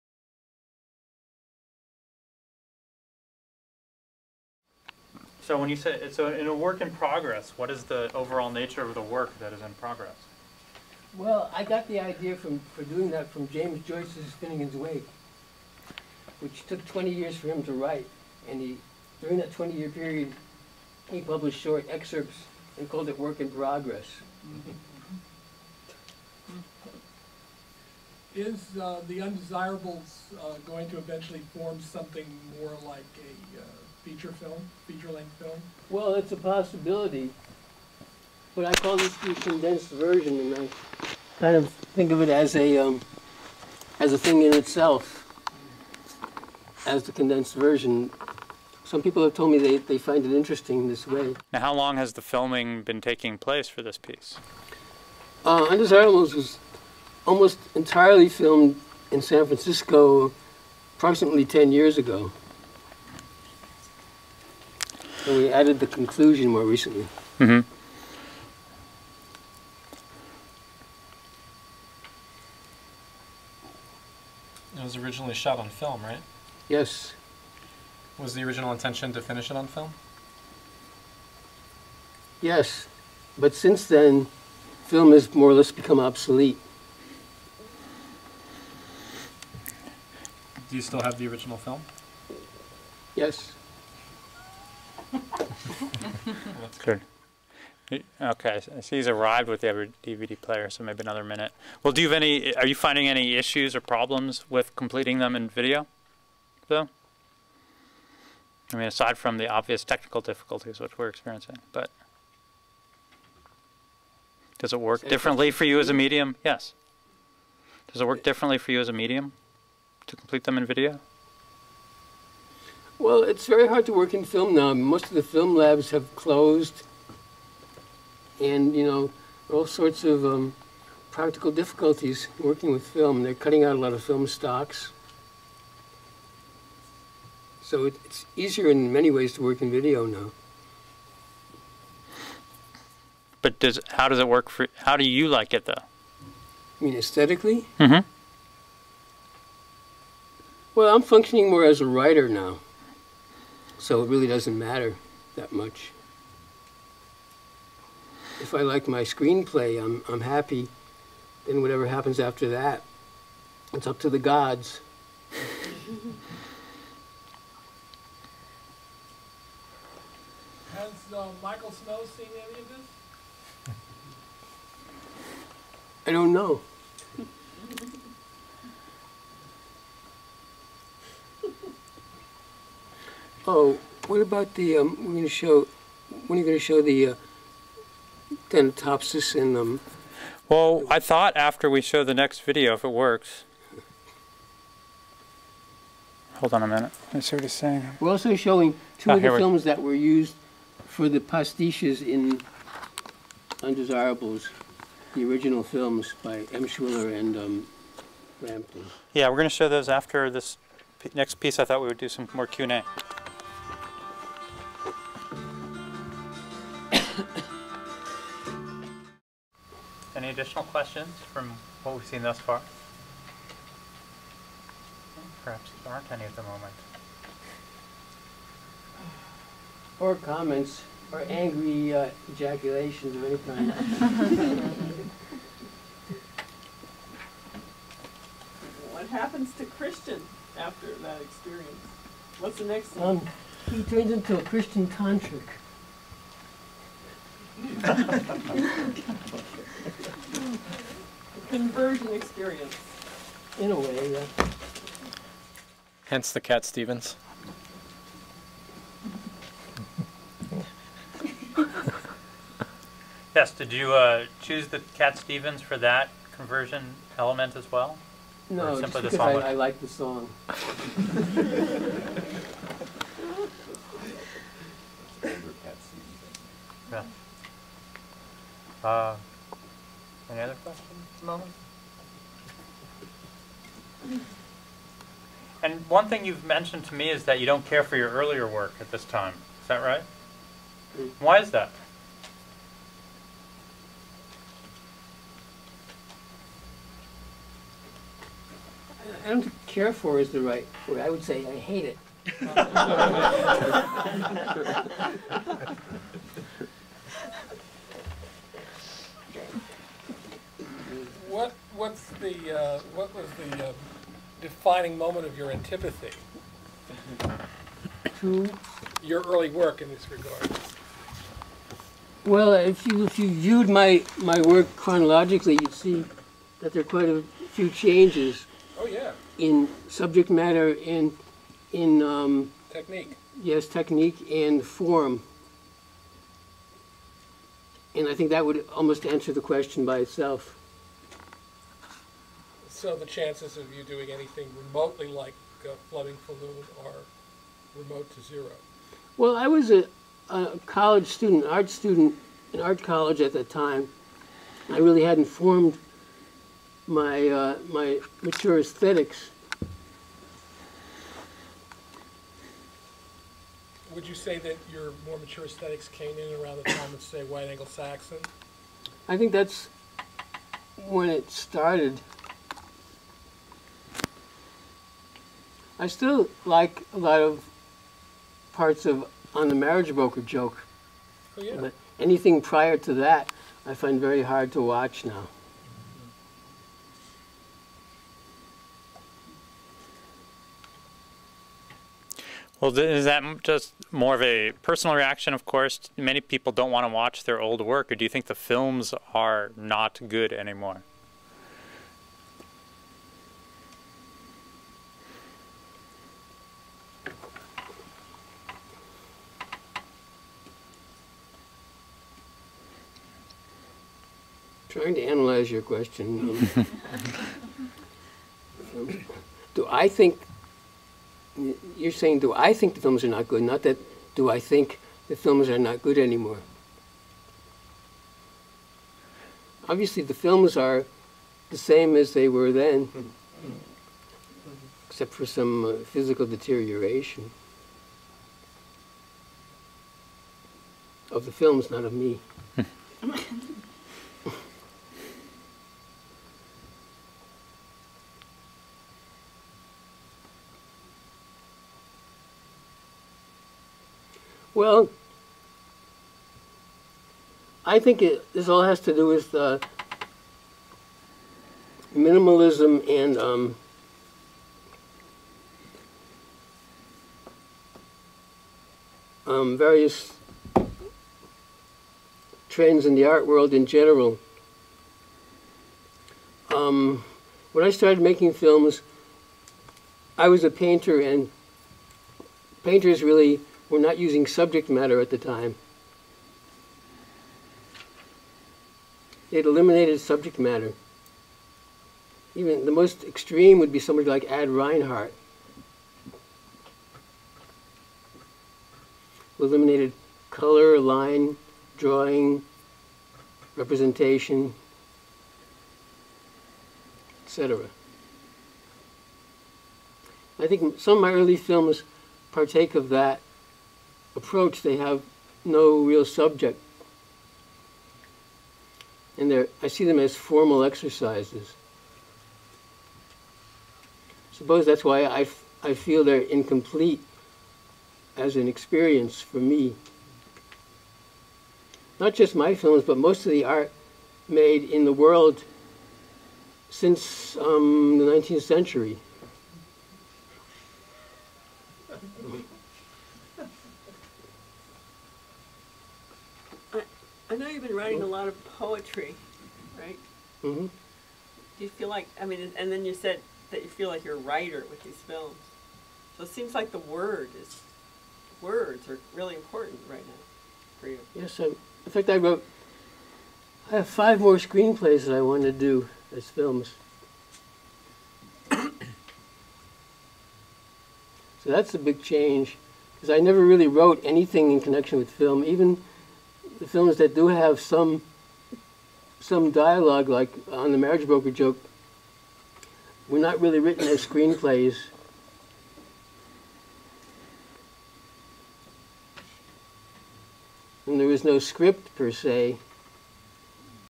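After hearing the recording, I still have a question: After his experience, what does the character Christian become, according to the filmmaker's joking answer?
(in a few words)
a Christian tantric.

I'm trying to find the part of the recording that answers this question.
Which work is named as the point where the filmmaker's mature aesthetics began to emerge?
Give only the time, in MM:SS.
06:07.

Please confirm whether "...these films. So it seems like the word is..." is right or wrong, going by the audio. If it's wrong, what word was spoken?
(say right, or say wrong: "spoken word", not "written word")
right.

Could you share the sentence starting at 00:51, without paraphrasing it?
Now, how long has the filming been taking place for this piece?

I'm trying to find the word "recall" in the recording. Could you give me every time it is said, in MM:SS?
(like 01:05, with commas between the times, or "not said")
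not said.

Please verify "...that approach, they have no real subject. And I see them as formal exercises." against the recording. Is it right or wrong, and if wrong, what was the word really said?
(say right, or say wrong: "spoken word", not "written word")
right.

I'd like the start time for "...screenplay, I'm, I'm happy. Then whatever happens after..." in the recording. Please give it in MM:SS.
02:39.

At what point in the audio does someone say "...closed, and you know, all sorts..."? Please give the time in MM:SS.
02:06.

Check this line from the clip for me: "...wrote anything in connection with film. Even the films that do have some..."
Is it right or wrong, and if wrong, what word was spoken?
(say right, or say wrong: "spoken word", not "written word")
right.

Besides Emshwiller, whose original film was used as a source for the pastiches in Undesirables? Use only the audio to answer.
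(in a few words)
Frampton.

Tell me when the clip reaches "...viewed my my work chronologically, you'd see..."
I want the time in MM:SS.
05:23.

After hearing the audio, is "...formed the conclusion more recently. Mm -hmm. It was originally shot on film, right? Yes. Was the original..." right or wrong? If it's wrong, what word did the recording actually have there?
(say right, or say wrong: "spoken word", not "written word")
wrong: "added", not "formed".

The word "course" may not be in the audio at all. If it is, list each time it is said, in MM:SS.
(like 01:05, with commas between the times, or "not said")
06:35.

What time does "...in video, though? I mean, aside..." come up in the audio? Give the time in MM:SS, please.
01:45.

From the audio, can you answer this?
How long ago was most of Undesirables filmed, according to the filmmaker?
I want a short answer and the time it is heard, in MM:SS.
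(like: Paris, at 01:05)
10 years, at 01:01.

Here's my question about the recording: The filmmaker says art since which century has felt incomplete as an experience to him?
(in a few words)
the 19th century.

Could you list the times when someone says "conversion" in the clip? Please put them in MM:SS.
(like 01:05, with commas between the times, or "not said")
04:11, 04:26.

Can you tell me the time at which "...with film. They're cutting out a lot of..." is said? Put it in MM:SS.
02:12.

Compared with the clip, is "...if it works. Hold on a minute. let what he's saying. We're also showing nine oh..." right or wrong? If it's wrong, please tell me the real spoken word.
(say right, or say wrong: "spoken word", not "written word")
wrong: "two", not "nine".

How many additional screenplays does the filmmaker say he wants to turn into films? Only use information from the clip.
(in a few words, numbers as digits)
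5.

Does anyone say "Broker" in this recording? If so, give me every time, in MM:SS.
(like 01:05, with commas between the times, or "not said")
06:19, 09:41.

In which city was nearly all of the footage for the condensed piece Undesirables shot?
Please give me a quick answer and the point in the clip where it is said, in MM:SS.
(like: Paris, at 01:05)
San Francisco, at 00:59.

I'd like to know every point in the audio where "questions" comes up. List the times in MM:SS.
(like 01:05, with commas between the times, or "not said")
03:40, 04:40, 05:39, 06:55.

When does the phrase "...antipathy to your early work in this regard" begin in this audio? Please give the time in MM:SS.
05:15.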